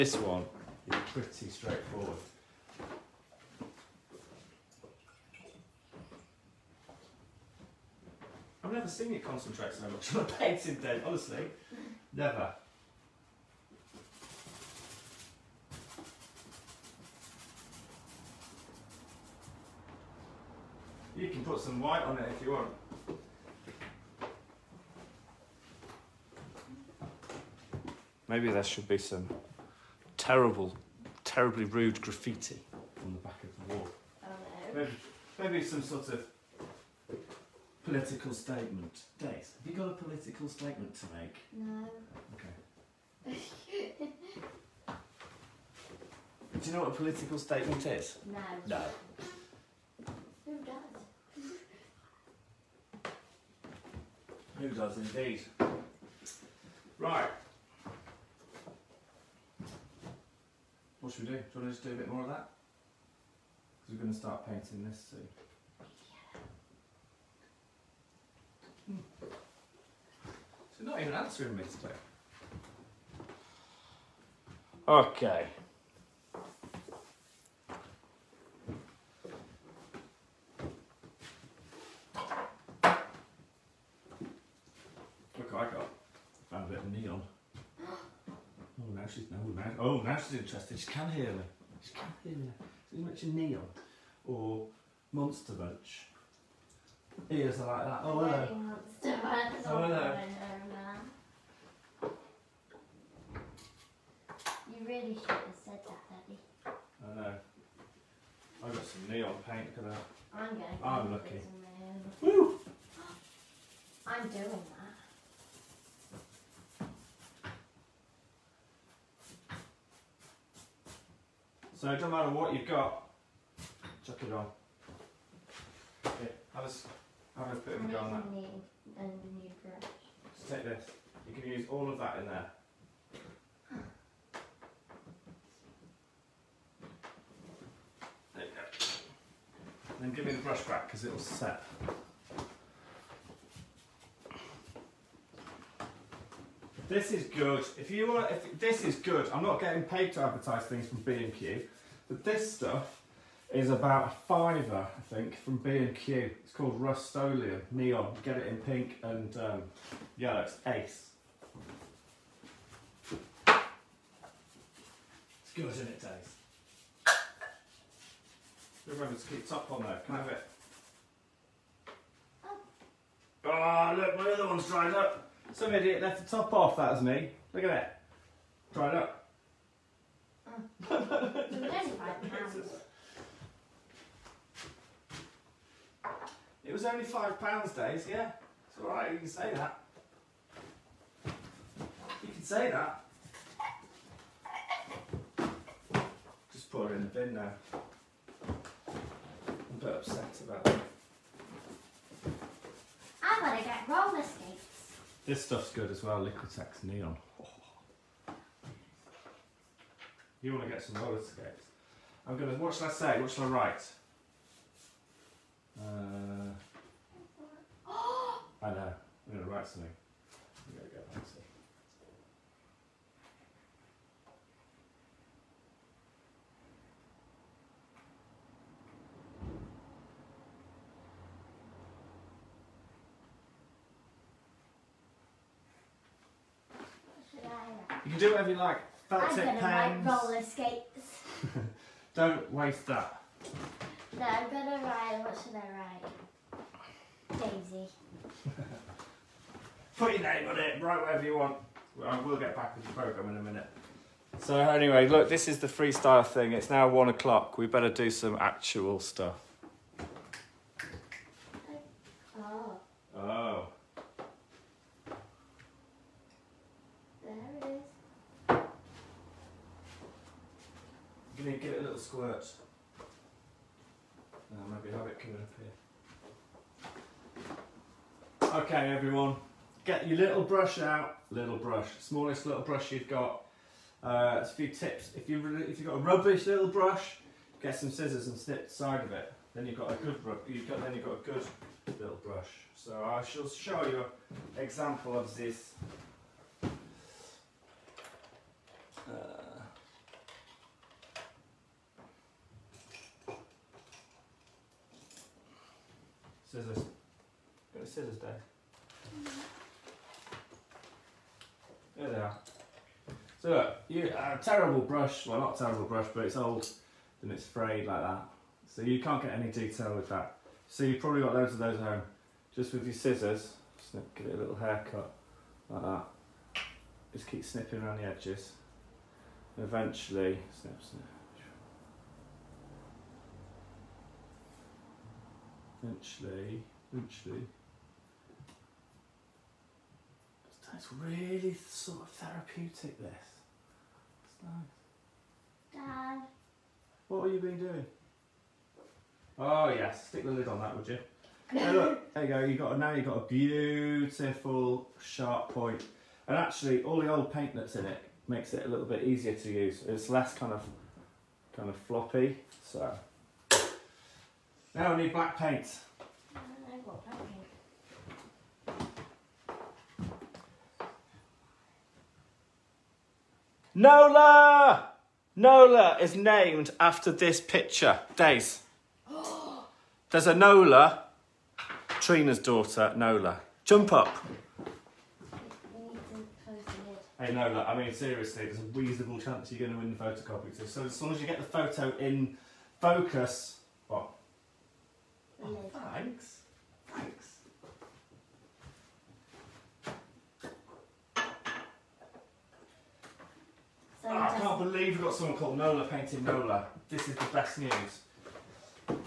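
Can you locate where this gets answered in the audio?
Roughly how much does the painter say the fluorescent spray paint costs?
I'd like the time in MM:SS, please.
02:33.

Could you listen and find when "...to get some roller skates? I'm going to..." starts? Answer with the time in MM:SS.
03:30.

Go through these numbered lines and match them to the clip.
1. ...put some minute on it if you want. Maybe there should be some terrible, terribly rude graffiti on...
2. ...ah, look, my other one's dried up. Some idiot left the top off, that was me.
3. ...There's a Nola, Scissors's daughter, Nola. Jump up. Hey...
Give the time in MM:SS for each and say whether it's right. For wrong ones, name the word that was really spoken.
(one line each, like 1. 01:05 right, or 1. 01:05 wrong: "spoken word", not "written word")
1. 00:21 wrong: "white", not "minute"
2. 02:53 right
3. 06:20 wrong: "Trina", not "Scissors".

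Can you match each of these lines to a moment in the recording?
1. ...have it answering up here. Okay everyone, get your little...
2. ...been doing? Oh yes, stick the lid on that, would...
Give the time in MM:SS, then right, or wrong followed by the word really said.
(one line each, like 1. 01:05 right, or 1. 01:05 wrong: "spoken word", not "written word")
1. 04:34 wrong: "coming", not "answering"
2. 05:47 right.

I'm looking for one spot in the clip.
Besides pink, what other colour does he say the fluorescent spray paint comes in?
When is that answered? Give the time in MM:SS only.
02:40.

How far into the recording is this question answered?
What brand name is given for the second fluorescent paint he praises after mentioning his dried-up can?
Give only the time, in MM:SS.
03:26.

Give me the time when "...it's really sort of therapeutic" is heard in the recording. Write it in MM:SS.
05:40.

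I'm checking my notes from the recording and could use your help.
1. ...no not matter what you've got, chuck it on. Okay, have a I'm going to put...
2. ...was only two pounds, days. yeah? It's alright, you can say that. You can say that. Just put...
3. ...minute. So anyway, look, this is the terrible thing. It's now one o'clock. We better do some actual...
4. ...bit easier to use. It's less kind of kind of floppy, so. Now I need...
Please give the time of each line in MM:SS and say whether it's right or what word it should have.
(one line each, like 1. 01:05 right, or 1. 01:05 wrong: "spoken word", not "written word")
1. 02:01 right
2. 03:06 wrong: "five", not "two"
3. 04:13 wrong: "freestyle", not "terrible"
4. 05:58 right.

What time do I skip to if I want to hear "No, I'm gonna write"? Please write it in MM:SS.
04:04.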